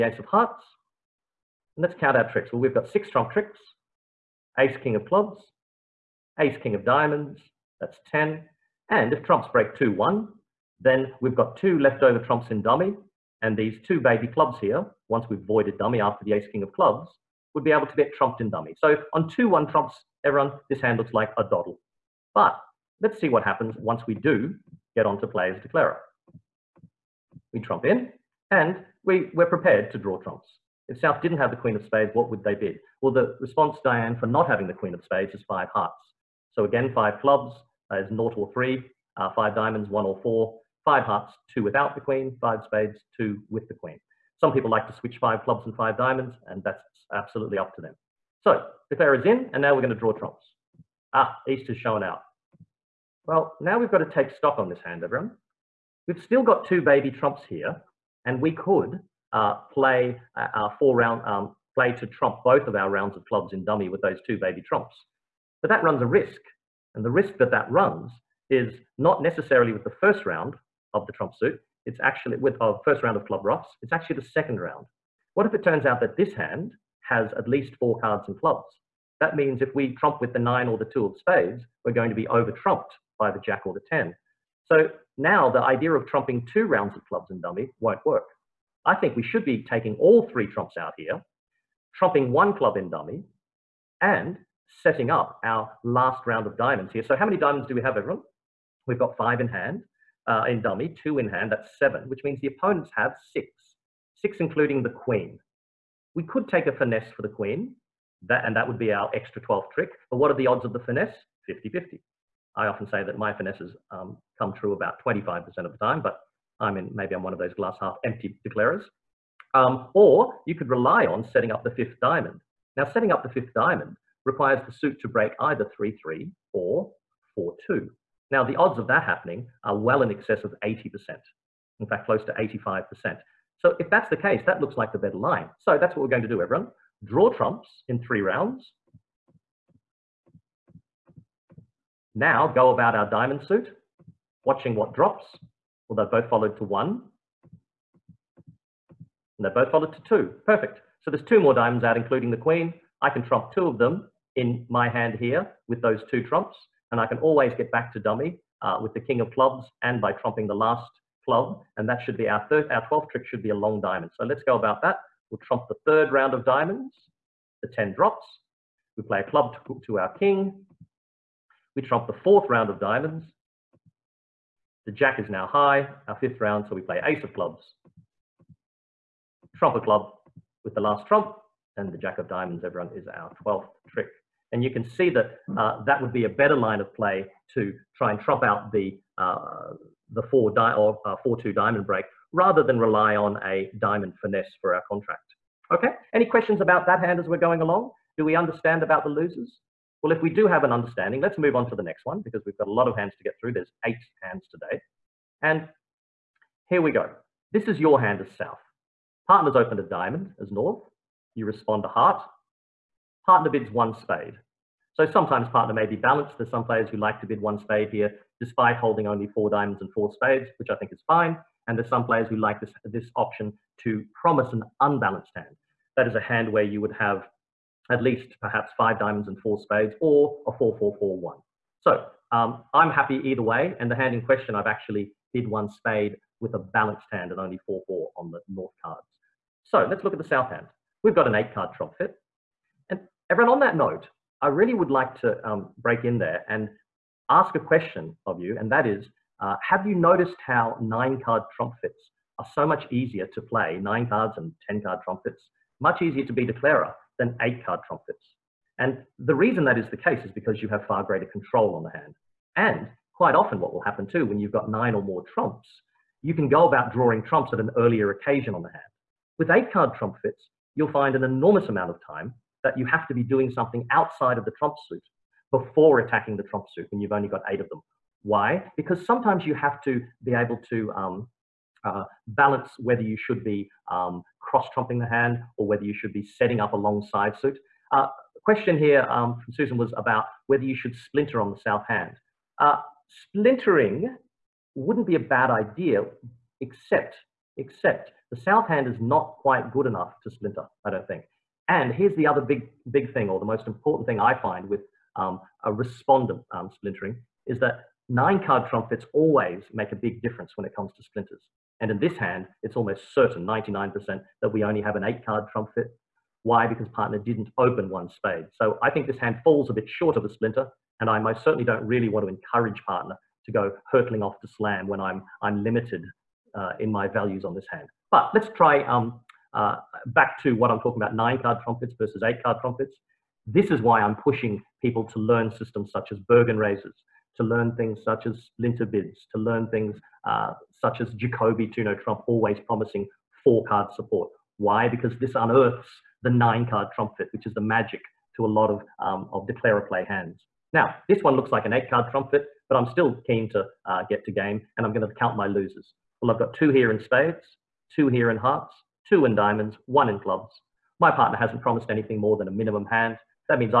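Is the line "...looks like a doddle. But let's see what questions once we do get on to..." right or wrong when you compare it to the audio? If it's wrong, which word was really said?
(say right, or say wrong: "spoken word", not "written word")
wrong: "happens", not "questions".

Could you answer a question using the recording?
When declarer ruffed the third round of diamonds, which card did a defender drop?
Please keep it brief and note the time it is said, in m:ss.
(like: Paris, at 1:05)
10, at 2:47.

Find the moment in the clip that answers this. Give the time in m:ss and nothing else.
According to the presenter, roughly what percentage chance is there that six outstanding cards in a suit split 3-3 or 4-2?
2:12.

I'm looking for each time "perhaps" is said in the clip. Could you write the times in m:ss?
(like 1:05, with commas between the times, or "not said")
3:48.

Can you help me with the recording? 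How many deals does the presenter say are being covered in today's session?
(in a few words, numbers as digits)
8.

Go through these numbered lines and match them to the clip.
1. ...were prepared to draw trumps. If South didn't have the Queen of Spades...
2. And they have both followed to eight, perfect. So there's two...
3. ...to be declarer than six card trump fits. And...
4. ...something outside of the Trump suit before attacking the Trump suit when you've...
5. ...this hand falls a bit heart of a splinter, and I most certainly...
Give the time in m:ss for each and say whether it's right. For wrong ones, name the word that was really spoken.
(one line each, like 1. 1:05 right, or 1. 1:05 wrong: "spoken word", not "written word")
1. 0:29 right
2. 2:28 wrong: "two", not "eight"
3. 4:16 wrong: "eight", not "six"
4. 4:33 right
5. 5:19 wrong: "short", not "heart".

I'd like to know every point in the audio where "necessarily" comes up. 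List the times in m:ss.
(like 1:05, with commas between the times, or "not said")
1:09.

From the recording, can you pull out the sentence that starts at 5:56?
Well, I've got two here in spades, two here in hearts, two in diamonds, one in clubs.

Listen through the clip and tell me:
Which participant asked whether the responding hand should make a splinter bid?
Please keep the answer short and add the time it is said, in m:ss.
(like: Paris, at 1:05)
Susan, at 4:49.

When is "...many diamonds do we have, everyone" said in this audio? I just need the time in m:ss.
1:37.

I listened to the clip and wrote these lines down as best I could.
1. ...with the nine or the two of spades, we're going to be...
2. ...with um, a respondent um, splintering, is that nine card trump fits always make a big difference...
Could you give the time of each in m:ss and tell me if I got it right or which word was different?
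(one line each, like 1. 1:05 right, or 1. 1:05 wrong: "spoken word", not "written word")
1. 1:20 right
2. 5:04 right.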